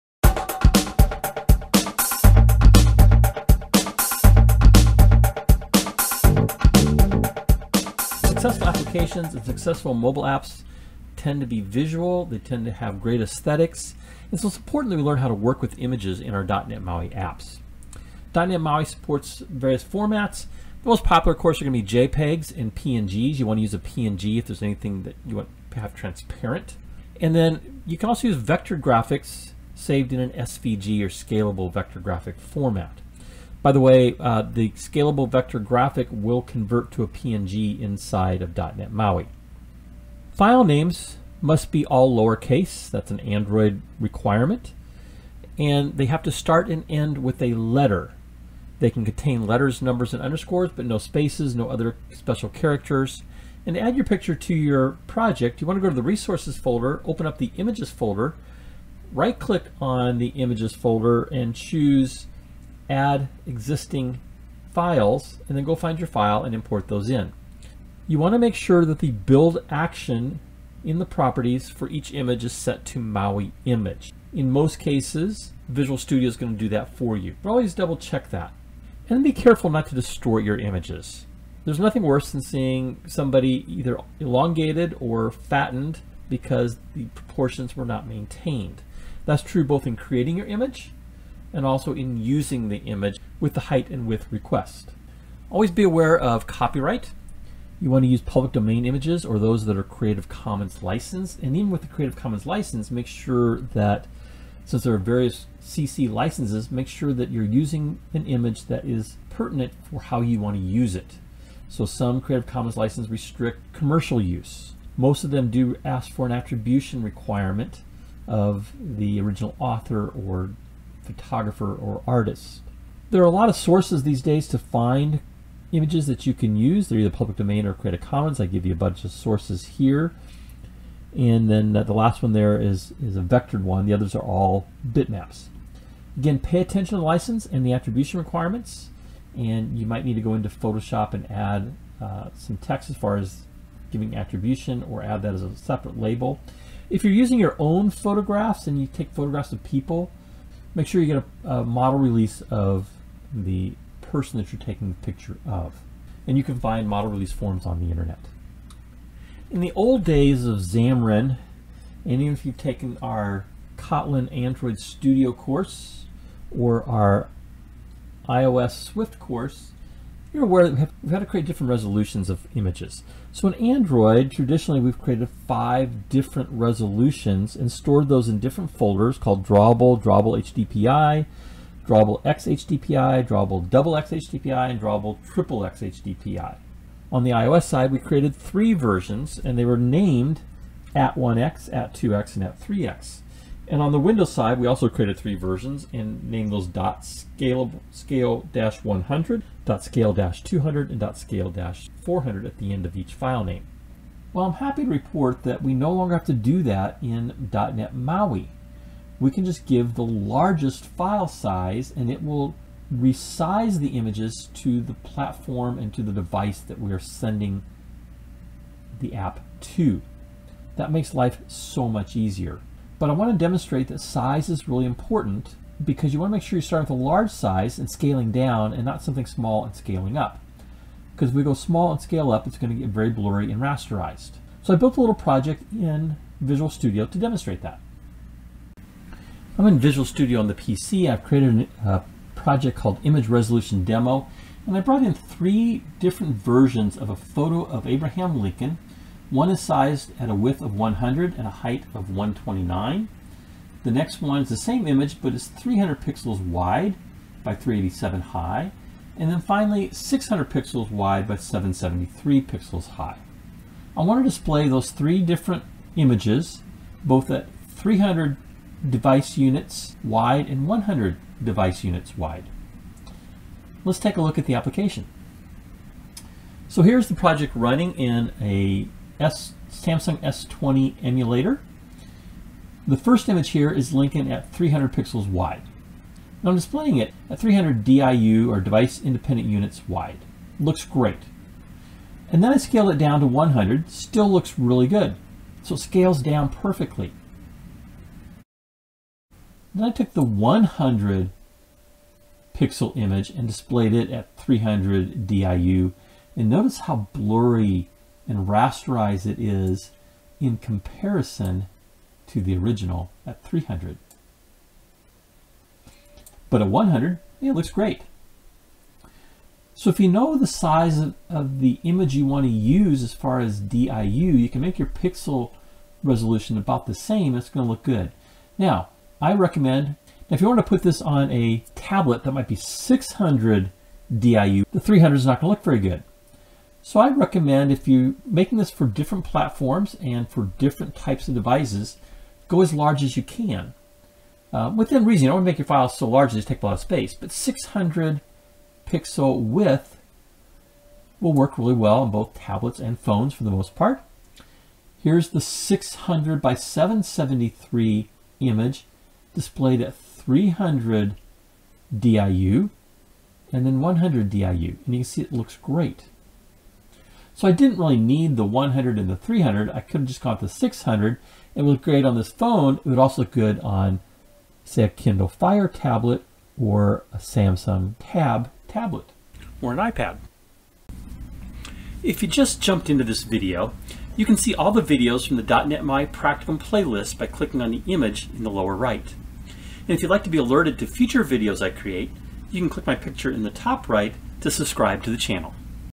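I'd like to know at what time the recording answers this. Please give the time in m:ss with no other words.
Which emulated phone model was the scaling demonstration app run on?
4:39.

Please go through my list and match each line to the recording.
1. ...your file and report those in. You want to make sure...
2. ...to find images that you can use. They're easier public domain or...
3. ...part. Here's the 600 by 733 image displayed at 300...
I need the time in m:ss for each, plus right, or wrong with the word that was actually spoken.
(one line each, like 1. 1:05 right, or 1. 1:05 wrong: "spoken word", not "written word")
1. 1:05 wrong: "import", not "report"
2. 2:04 wrong: "either", not "easier"
3. 5:53 wrong: "773", not "733".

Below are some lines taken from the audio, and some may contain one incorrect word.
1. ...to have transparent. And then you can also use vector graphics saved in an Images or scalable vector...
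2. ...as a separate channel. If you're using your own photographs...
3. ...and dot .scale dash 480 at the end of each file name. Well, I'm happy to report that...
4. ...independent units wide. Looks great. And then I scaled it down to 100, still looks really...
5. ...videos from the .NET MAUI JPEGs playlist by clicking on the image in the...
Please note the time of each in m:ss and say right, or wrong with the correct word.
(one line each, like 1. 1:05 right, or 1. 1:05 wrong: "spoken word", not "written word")
1. 0:25 wrong: "SVG", not "Images"
2. 2:25 wrong: "label", not "channel"
3. 3:20 wrong: "400", not "480"
4. 4:48 right
5. 6:24 wrong: "Practicum", not "JPEGs".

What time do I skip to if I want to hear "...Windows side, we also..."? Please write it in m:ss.
3:13.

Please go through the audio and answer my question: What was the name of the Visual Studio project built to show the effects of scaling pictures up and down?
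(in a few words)
Image Resolution Demo.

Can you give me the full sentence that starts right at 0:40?
File names must be all lowercase.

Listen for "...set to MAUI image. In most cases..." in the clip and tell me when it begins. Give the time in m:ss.
1:12.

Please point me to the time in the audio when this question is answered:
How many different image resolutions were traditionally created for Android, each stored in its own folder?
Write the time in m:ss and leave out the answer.
2:55.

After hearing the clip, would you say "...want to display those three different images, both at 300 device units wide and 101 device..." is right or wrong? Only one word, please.
wrong.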